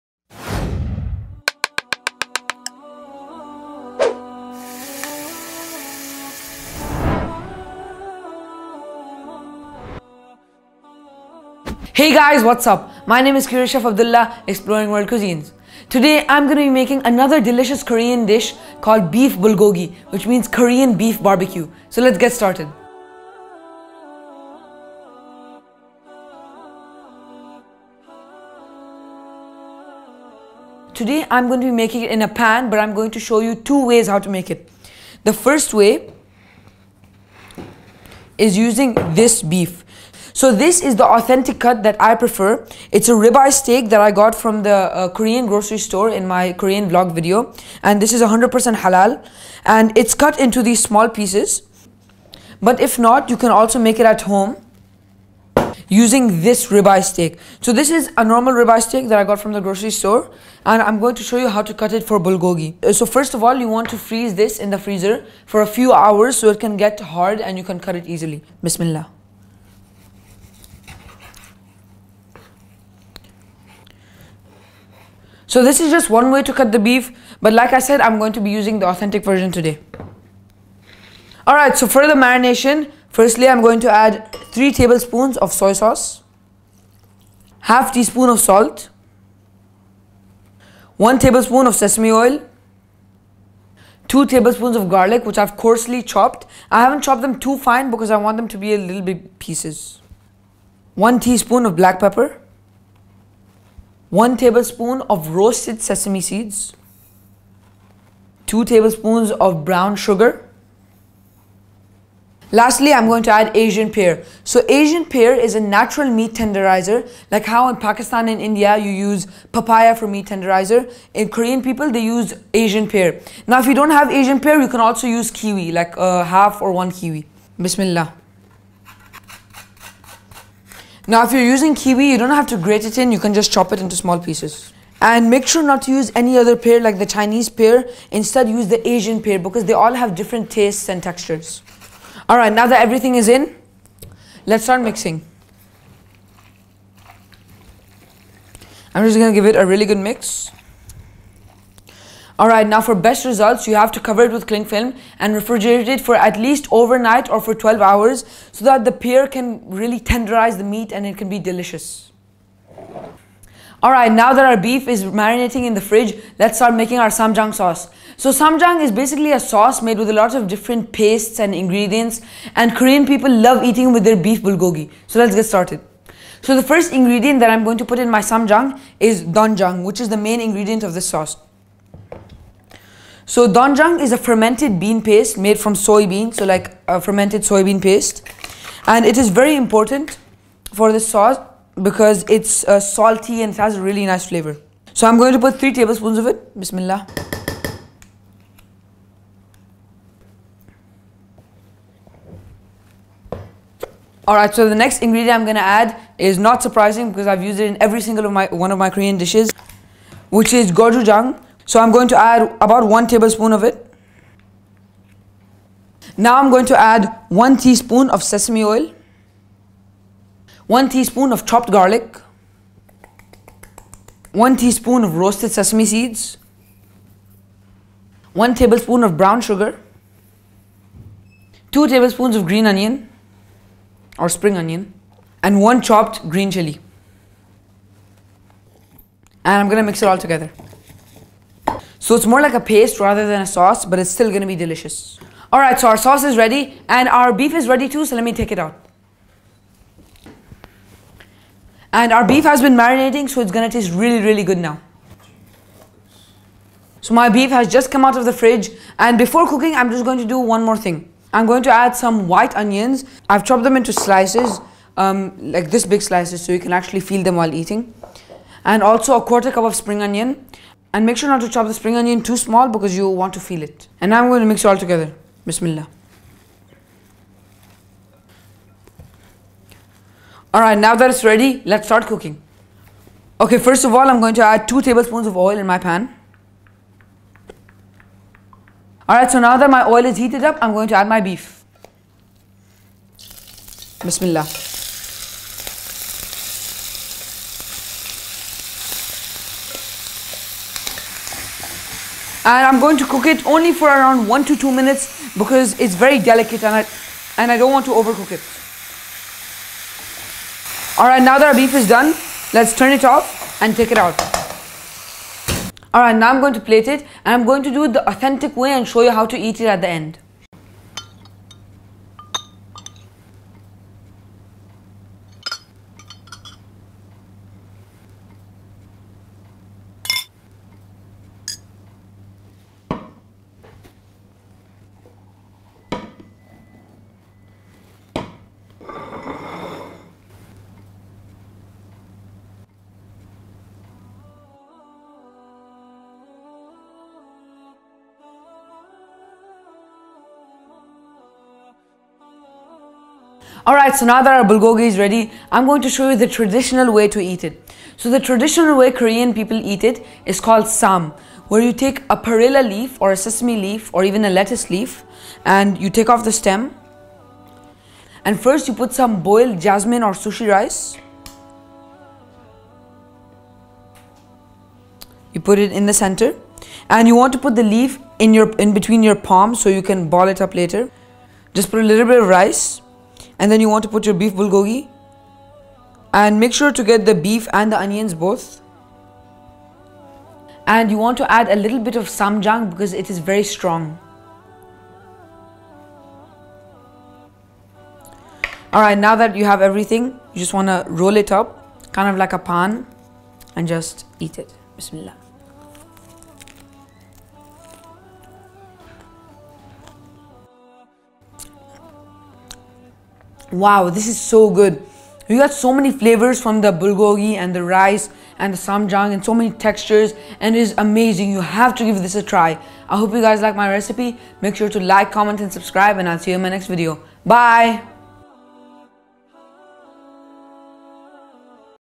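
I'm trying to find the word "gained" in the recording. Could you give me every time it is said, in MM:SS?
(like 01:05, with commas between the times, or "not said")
not said.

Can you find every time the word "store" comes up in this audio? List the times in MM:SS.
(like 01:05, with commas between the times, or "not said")
00:45, 00:59.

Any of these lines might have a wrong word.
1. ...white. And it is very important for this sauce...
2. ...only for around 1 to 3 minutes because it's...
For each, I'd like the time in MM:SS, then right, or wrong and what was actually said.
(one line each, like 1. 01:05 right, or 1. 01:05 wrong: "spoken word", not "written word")
1. 03:07 wrong: "paste", not "white"
2. 05:03 wrong: "2", not "3".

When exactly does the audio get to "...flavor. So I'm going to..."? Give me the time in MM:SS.
03:14.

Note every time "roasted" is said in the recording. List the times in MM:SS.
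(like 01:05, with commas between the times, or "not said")
01:45, 03:45.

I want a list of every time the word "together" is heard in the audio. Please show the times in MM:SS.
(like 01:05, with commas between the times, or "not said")
04:00, 04:34.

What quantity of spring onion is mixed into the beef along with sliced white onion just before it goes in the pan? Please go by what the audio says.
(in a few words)
a quarter cup.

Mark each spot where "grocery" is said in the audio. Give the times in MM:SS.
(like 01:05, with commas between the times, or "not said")
00:45, 00:59.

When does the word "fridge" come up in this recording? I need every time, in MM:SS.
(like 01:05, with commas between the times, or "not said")
02:45, 04:18.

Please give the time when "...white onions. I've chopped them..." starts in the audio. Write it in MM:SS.
04:22.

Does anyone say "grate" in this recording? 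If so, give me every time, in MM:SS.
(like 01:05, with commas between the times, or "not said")
02:12.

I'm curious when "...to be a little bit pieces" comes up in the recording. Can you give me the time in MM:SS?
01:38.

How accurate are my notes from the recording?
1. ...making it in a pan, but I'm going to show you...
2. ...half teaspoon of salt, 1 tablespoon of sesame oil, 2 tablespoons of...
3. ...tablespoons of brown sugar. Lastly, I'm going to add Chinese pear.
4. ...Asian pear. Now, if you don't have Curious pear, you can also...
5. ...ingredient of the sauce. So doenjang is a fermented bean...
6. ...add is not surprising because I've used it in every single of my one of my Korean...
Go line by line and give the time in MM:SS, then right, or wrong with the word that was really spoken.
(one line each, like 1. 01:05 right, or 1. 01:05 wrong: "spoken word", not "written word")
1. 00:31 right
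2. 01:27 right
3. 01:48 wrong: "Asian", not "Chinese"
4. 02:02 wrong: "Asian", not "Curious"
5. 03:00 right
6. 03:25 right.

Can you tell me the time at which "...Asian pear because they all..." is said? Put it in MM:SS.
02:18.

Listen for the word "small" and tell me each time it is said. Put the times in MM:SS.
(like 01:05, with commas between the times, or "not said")
00:50, 02:13, 04:32.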